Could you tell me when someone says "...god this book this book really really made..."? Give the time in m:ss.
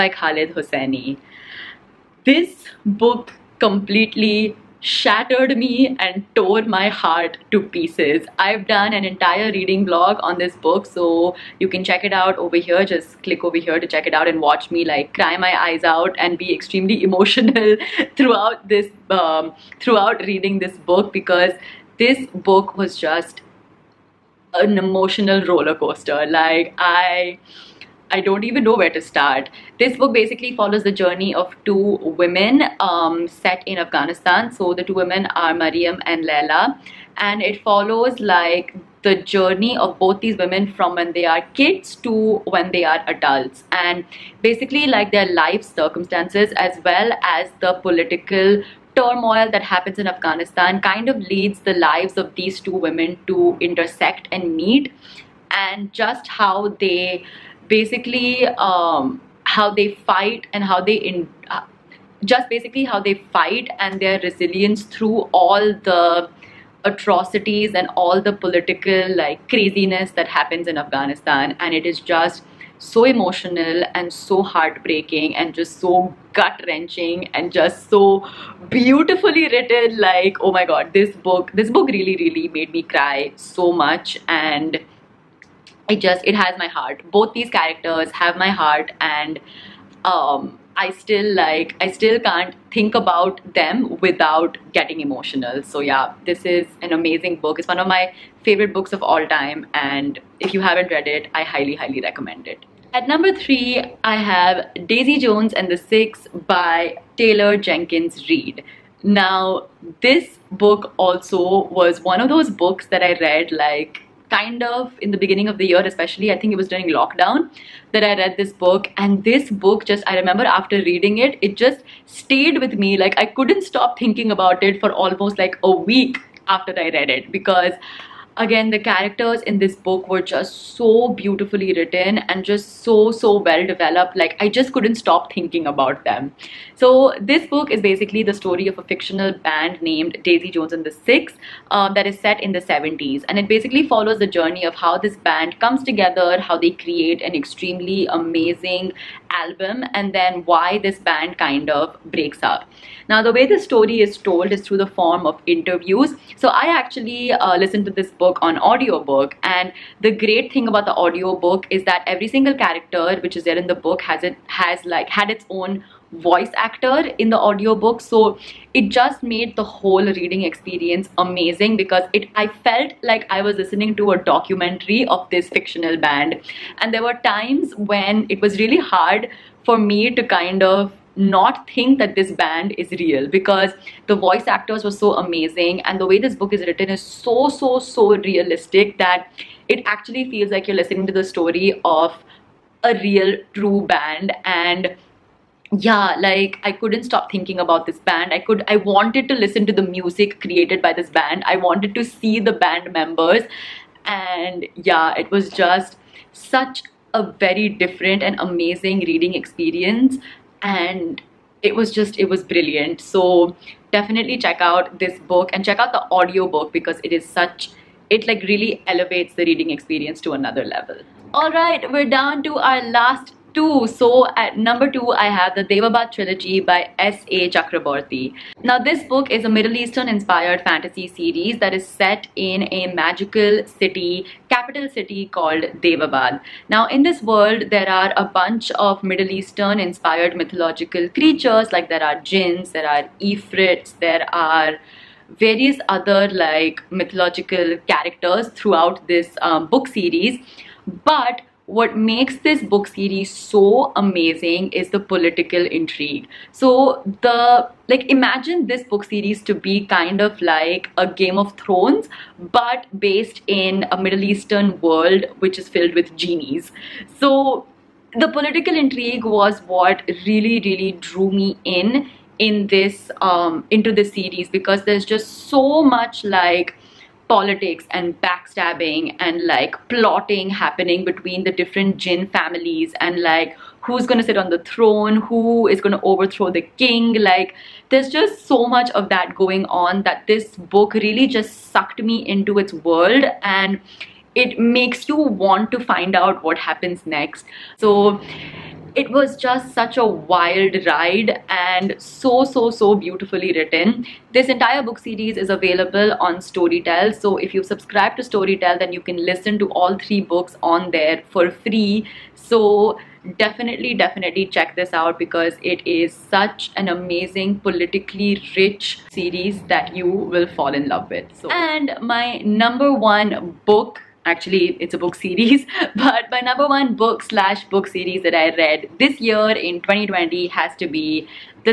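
1:20.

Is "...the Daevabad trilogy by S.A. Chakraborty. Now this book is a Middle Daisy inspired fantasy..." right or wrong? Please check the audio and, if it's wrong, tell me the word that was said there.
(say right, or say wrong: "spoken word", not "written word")
wrong: "Eastern", not "Daisy".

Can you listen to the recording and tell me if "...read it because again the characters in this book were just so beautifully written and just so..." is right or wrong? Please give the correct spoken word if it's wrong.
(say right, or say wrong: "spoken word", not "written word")
right.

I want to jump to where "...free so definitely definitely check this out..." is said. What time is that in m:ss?
5:11.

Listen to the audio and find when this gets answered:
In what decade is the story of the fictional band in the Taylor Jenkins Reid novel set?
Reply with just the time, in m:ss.
2:22.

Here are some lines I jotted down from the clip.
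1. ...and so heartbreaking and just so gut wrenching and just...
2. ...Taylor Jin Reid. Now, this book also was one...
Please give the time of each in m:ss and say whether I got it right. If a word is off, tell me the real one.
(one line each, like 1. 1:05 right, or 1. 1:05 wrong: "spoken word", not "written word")
1. 1:13 right
2. 1:47 wrong: "Jenkins", not "Jin".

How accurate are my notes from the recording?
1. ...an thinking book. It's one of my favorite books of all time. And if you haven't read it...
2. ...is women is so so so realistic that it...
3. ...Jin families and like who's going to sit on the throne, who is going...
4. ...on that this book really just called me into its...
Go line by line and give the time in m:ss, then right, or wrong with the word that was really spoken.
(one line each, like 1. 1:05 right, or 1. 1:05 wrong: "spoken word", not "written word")
1. 1:36 wrong: "amazing", not "thinking"
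2. 3:06 wrong: "written", not "women"
3. 4:41 right
4. 4:49 wrong: "sucked", not "called".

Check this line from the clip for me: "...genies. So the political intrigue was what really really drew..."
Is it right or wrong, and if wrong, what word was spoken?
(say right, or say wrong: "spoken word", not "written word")
right.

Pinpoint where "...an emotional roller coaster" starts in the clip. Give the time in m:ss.
0:24.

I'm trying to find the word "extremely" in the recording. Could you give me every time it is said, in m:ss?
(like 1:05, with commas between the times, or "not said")
0:16, 2:27.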